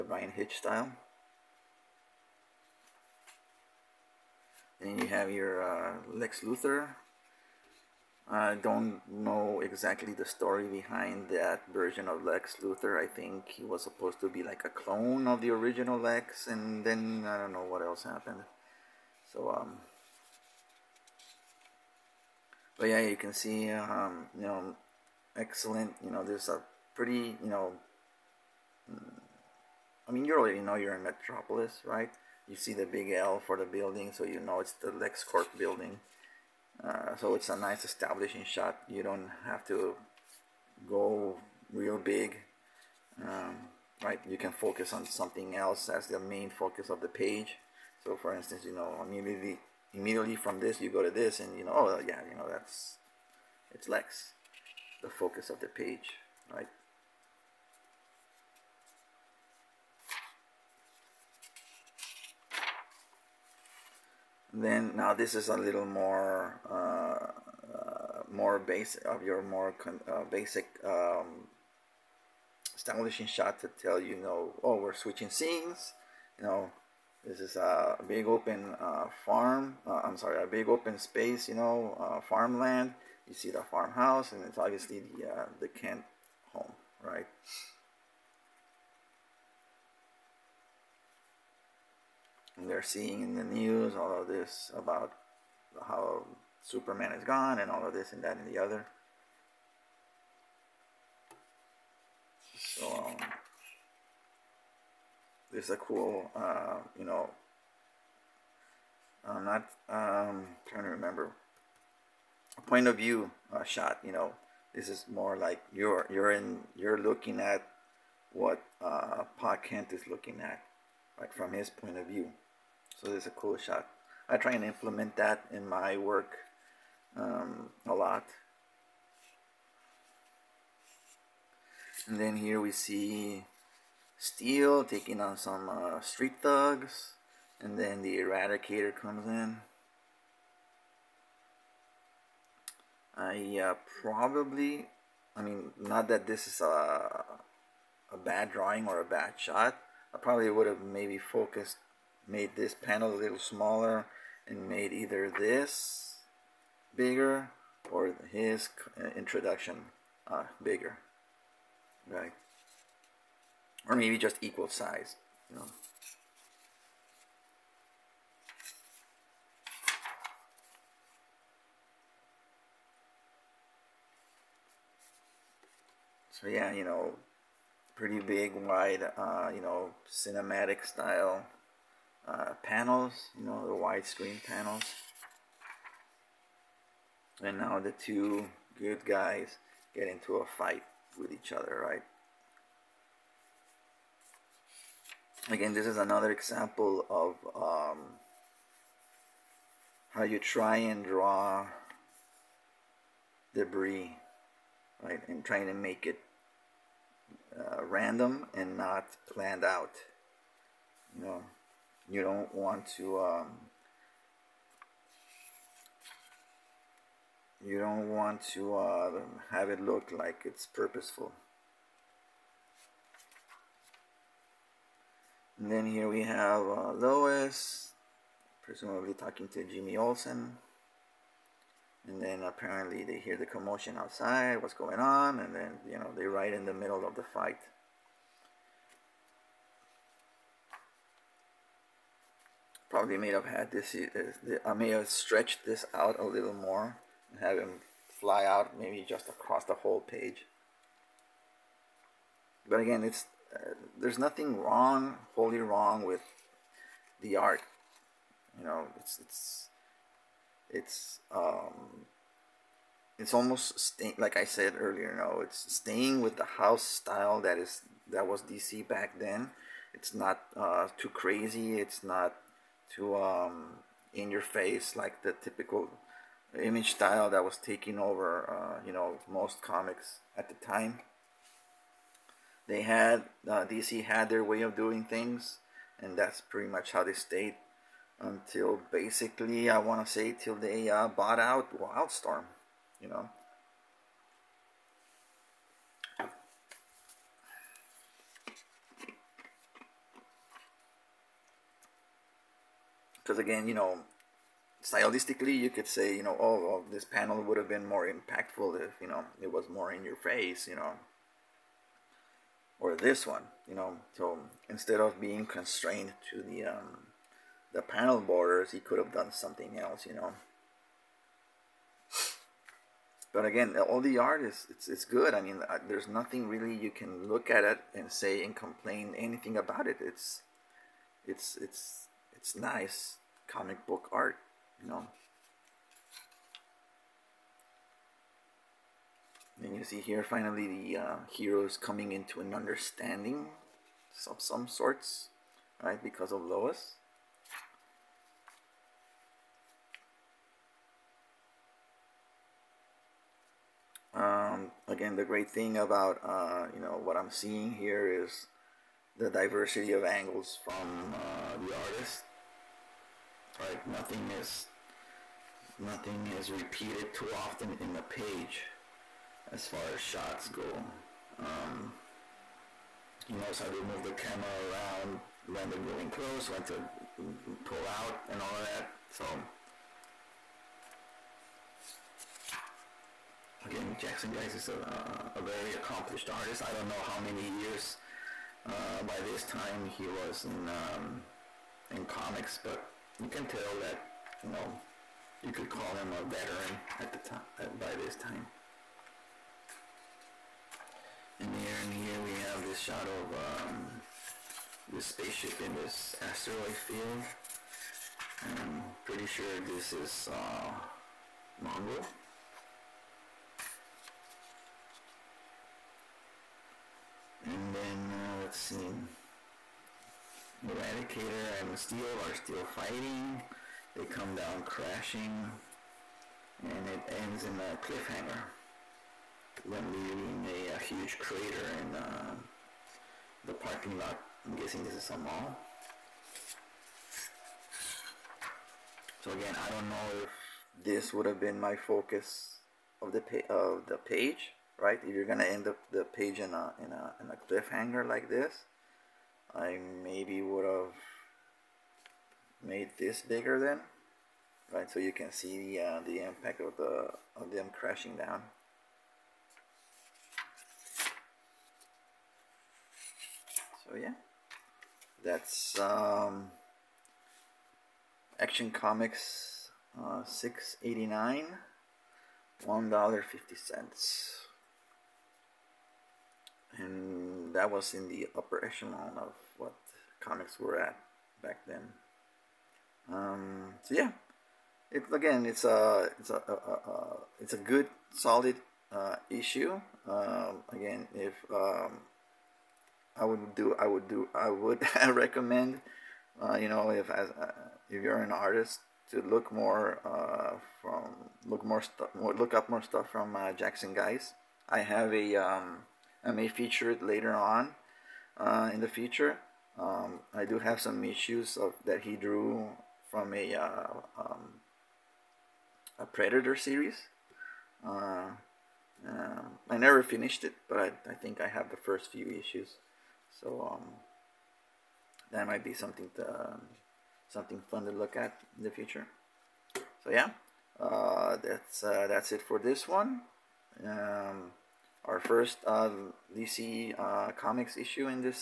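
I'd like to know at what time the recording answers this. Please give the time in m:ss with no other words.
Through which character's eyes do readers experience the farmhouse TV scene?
1:59.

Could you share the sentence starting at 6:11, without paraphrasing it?
Um, he knows how to move the camera around when they're going close, when to pull out, and all of that.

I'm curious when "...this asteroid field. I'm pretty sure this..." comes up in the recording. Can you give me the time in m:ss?
6:45.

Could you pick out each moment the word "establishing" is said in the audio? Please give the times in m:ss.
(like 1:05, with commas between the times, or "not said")
0:37, 1:12.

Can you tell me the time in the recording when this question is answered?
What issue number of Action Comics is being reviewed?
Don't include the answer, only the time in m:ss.
7:50.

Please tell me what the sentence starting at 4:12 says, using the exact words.
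But again, it's uh, there's nothing wrong, wholly wrong with the art.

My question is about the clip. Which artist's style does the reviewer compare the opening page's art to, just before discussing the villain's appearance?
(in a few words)
Bryan Hitch.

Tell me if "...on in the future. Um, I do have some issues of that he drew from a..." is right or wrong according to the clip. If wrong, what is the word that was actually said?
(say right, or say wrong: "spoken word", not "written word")
right.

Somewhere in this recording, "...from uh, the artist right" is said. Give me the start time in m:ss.
6:00.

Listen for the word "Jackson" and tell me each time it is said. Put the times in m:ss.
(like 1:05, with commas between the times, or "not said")
6:24, 8:23.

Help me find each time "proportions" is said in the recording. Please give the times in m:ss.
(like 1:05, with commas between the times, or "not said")
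not said.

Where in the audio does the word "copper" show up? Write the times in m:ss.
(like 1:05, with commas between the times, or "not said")
not said.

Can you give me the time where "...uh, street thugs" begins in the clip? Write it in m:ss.
2:15.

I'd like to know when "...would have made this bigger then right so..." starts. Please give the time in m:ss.
7:30.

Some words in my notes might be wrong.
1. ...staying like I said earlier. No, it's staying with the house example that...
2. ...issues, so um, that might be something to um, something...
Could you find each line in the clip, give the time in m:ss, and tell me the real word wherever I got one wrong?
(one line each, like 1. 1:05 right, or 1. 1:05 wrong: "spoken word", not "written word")
1. 4:23 wrong: "style", not "example"
2. 8:42 right.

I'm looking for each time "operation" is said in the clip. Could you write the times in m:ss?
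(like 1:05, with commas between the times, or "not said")
7:58.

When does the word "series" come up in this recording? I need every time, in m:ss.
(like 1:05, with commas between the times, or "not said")
8:36.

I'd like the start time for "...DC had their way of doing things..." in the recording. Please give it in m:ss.
4:43.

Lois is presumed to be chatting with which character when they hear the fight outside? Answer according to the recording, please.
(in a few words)
Jimmy Olsen.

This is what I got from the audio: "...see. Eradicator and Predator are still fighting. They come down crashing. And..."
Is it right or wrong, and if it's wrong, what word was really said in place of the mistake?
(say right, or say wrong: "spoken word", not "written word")
wrong: "Steel", not "Predator".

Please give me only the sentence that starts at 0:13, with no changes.
I think he was supposed to be like a clone of the original Lex, and then I don't know what else happened.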